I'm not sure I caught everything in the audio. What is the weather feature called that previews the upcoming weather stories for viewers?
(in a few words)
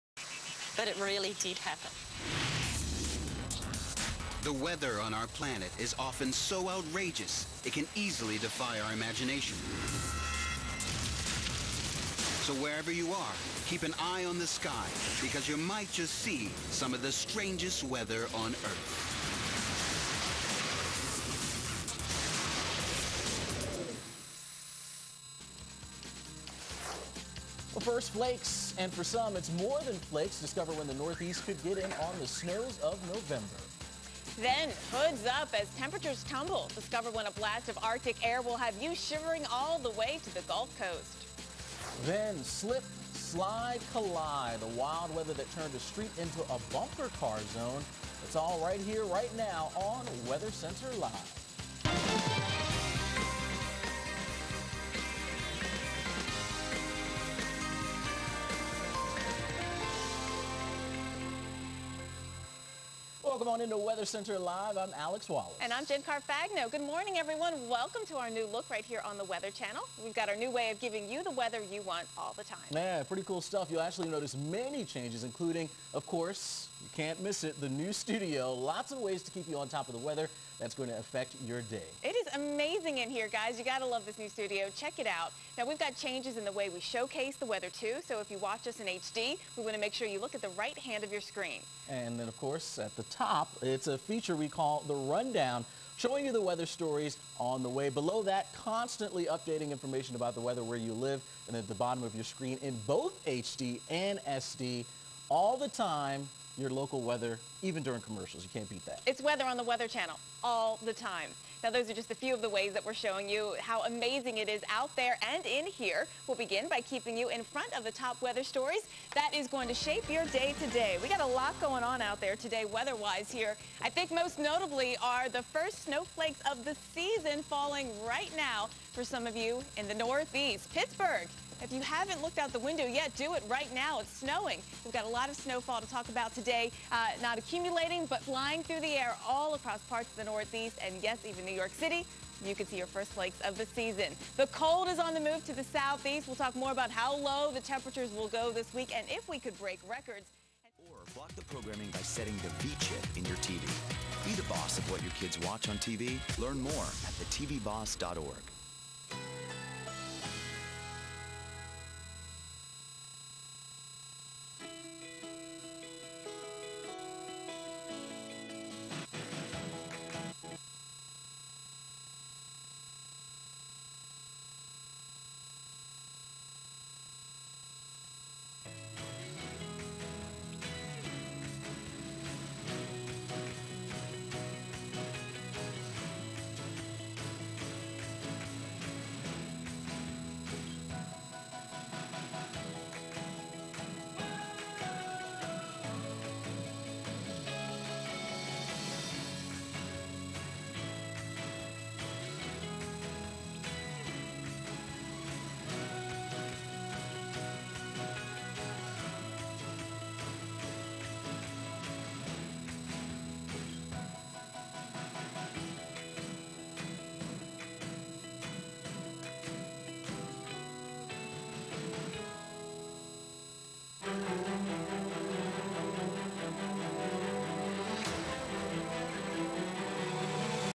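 the Rundown.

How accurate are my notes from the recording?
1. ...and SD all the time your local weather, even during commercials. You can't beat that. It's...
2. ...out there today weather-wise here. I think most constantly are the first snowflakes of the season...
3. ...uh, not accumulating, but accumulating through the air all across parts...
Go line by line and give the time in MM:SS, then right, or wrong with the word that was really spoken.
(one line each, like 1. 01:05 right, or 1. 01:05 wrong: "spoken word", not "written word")
1. 01:43 right
2. 02:02 wrong: "notably", not "constantly"
3. 02:16 wrong: "flying", not "accumulating".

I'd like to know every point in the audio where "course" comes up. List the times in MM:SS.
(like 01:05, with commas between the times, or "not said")
01:16, 01:32.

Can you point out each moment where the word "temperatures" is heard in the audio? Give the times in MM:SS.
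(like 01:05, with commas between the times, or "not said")
00:35, 02:27.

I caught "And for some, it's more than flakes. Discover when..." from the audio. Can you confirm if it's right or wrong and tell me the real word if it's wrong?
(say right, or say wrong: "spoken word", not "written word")
right.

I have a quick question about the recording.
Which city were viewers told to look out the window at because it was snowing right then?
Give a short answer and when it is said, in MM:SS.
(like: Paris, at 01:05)
Pittsburgh, at 02:10.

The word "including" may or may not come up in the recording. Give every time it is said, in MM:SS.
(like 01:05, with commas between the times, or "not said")
01:15.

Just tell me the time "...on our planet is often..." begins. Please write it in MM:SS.
00:05.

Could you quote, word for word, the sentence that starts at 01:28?
So if you watch us in HD, we want to make sure you look at the right hand of your screen.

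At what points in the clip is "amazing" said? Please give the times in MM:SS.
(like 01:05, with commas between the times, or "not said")
01:22, 01:53.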